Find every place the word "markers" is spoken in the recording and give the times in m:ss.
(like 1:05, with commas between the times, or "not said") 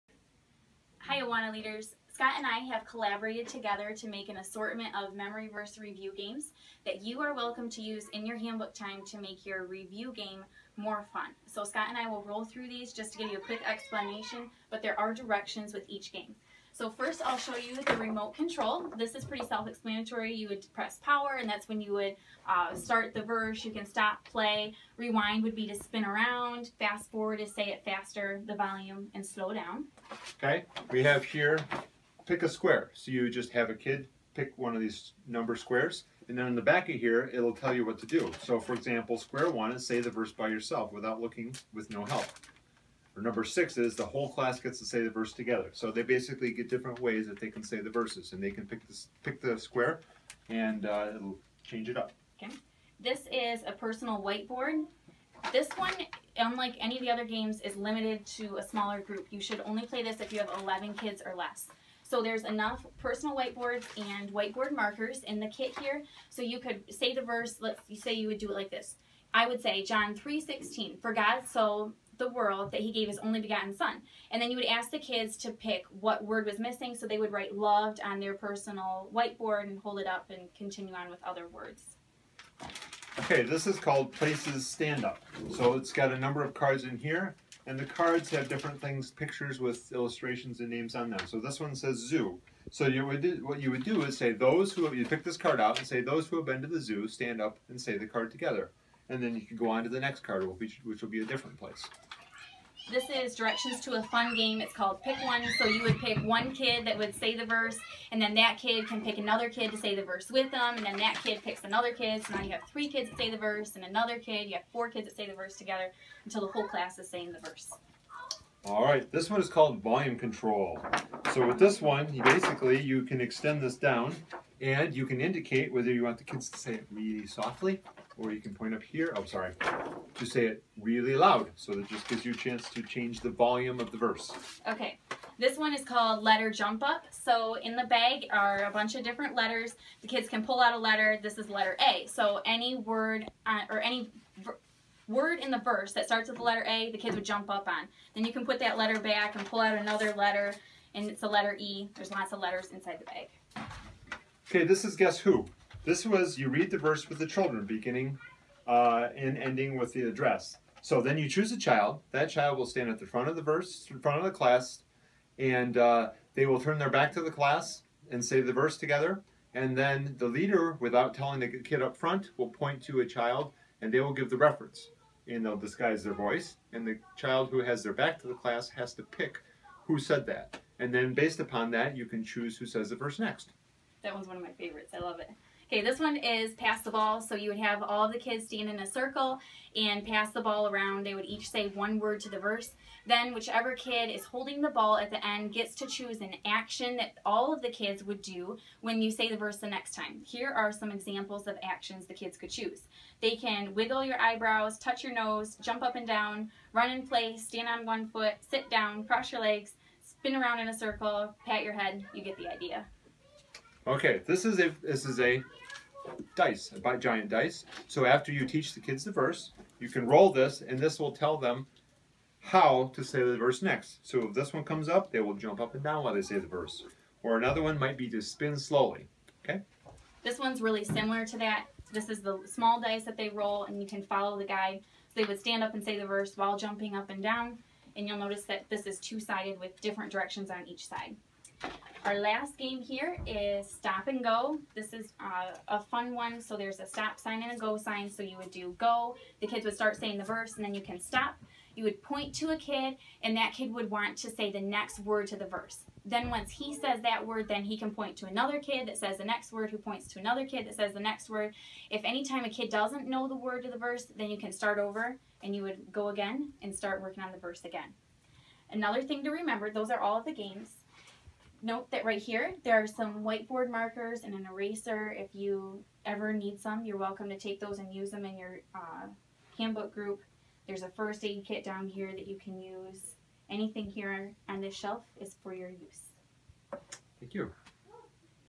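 1:04, 4:33.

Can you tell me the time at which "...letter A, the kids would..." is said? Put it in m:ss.
2:26.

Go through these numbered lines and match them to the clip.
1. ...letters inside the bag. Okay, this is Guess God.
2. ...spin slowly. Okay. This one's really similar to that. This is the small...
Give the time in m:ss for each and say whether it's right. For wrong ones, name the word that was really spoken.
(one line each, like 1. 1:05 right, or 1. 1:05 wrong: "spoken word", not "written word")
1. 2:32 wrong: "Who", not "God"
2. 3:48 right.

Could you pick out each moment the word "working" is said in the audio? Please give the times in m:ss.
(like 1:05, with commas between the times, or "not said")
4:27.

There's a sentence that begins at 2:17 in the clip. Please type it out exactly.
So in the bag are a bunch of different letters.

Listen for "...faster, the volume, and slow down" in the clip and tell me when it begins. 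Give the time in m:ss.
0:27.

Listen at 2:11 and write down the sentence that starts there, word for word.
So that just gives you a chance to change the volume of the verse.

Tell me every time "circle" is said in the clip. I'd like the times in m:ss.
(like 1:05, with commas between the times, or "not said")
3:08, 3:30.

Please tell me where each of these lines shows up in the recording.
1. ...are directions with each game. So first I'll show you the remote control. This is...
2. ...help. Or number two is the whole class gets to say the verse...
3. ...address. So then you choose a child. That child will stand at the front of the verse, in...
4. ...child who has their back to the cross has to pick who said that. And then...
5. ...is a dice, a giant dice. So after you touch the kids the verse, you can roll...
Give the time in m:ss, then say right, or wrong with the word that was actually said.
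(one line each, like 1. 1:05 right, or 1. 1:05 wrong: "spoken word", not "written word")
1. 0:14 right
2. 0:42 wrong: "six", not "two"
3. 2:40 right
4. 2:57 wrong: "class", not "cross"
5. 3:35 wrong: "teach", not "touch".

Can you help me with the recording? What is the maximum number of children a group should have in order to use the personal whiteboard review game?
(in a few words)
11.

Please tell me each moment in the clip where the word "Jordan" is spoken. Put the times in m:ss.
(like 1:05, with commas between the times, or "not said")
not said.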